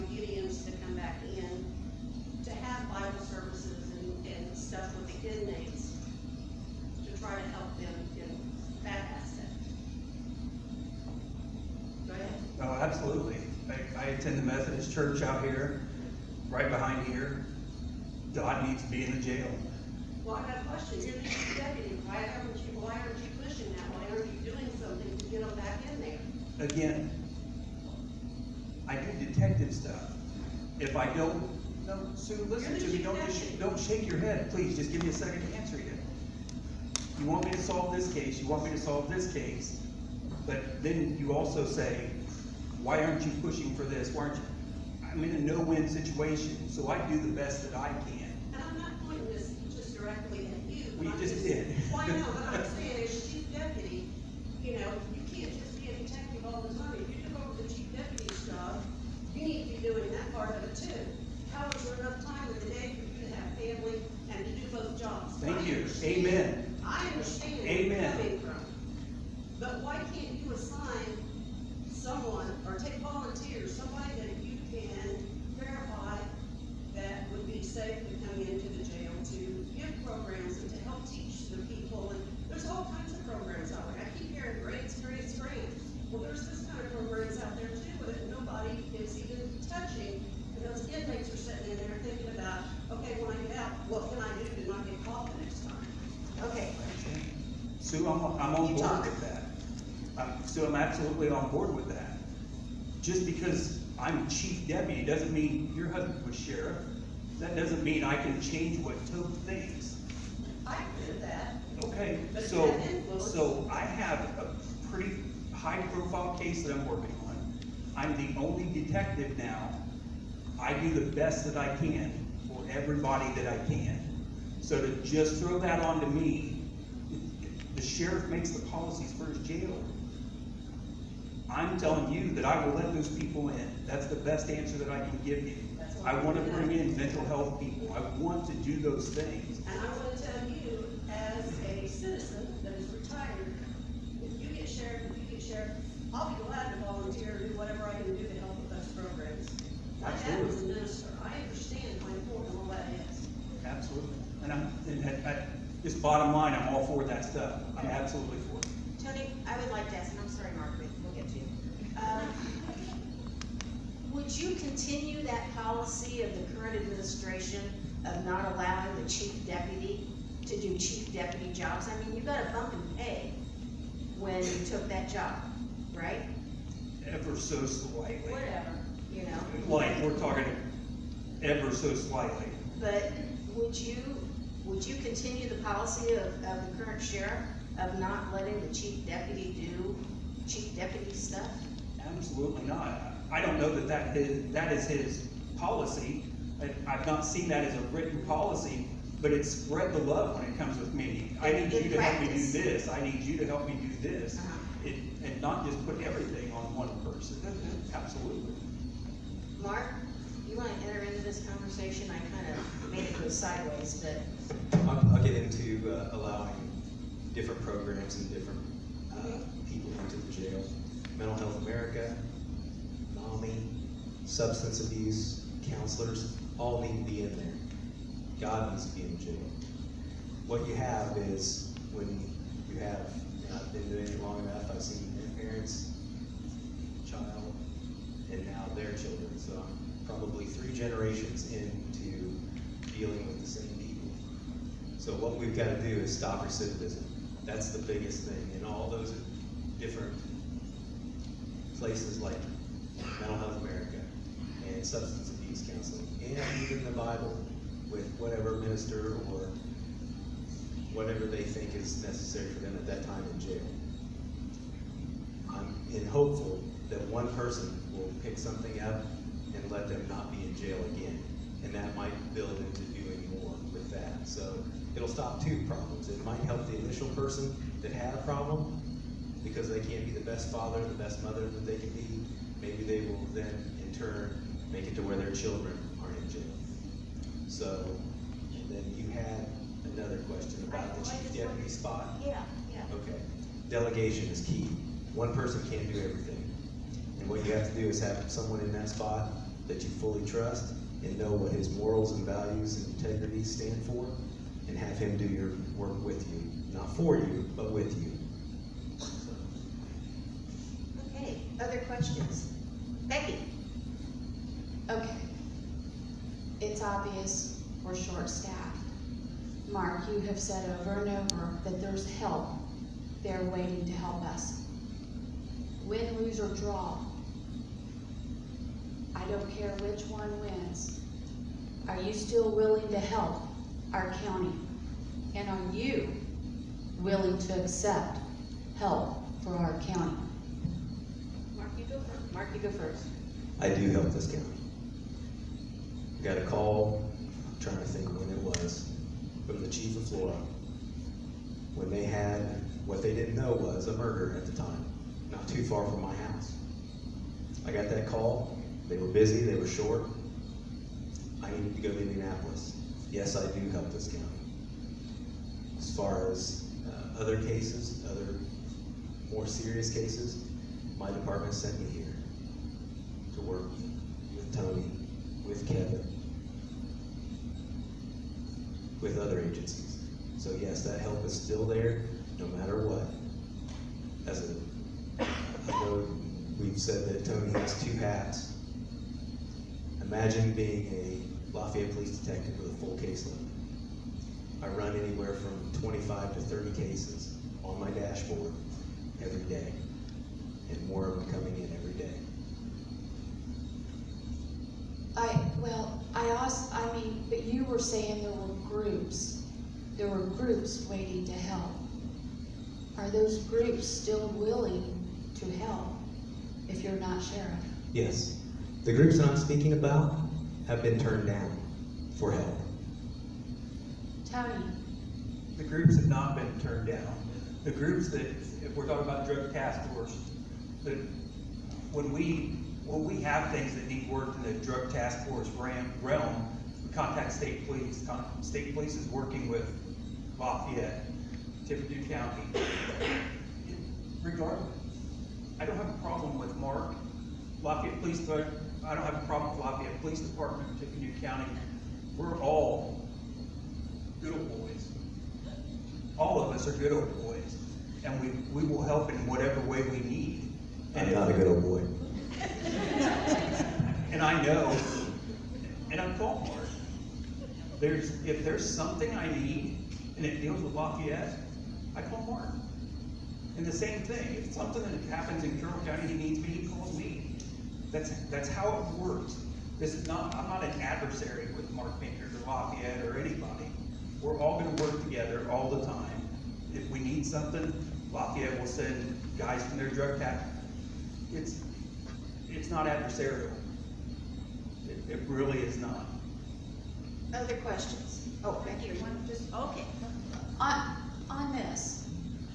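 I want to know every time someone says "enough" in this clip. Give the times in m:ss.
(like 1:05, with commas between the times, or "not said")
3:54.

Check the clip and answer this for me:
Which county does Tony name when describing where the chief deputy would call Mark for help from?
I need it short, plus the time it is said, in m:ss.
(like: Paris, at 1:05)
Carroll County, at 7:55.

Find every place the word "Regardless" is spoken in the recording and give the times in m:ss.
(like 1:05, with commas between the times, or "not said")
7:24.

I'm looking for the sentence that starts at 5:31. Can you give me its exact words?
Are you still willing to help our county?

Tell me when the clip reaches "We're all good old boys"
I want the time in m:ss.
7:32.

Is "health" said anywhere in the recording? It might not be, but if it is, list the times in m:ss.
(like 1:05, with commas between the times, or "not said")
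2:17, 3:41, 4:13.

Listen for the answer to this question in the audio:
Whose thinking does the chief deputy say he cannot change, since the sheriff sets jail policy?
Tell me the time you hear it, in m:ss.
1:49.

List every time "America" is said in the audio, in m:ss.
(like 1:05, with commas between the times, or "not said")
3:41, 4:13.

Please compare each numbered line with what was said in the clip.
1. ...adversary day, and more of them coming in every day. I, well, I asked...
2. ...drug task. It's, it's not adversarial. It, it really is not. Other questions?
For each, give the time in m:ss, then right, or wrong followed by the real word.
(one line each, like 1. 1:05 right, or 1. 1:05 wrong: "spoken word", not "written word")
1. 6:39 wrong: "every", not "adversary"
2. 8:09 right.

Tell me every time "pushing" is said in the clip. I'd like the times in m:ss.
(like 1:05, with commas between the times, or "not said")
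0:23, 0:43.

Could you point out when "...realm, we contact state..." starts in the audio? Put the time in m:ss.
7:15.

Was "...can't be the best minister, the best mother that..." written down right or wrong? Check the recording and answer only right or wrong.
wrong.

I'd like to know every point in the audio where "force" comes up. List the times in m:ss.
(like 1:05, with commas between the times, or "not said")
7:09, 7:15.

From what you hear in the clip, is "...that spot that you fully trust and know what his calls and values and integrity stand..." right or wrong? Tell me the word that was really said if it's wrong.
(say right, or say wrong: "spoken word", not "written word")
wrong: "morals", not "calls".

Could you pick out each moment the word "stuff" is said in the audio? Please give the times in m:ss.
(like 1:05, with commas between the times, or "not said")
0:29, 2:37, 3:11.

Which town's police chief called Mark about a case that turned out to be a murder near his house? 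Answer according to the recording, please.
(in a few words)
Flora.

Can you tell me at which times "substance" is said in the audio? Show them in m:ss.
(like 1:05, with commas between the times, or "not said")
3:44, 4:14.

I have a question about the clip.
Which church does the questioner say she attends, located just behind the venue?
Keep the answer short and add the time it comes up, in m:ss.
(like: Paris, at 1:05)
Methodist church, at 0:14.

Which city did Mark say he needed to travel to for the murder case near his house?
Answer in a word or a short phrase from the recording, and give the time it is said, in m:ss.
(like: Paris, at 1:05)
Indianapolis, at 6:02.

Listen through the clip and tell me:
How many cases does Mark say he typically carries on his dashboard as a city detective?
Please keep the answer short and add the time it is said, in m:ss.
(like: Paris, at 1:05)
25 to 30, at 6:35.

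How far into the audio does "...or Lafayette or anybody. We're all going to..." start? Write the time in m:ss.
8:02.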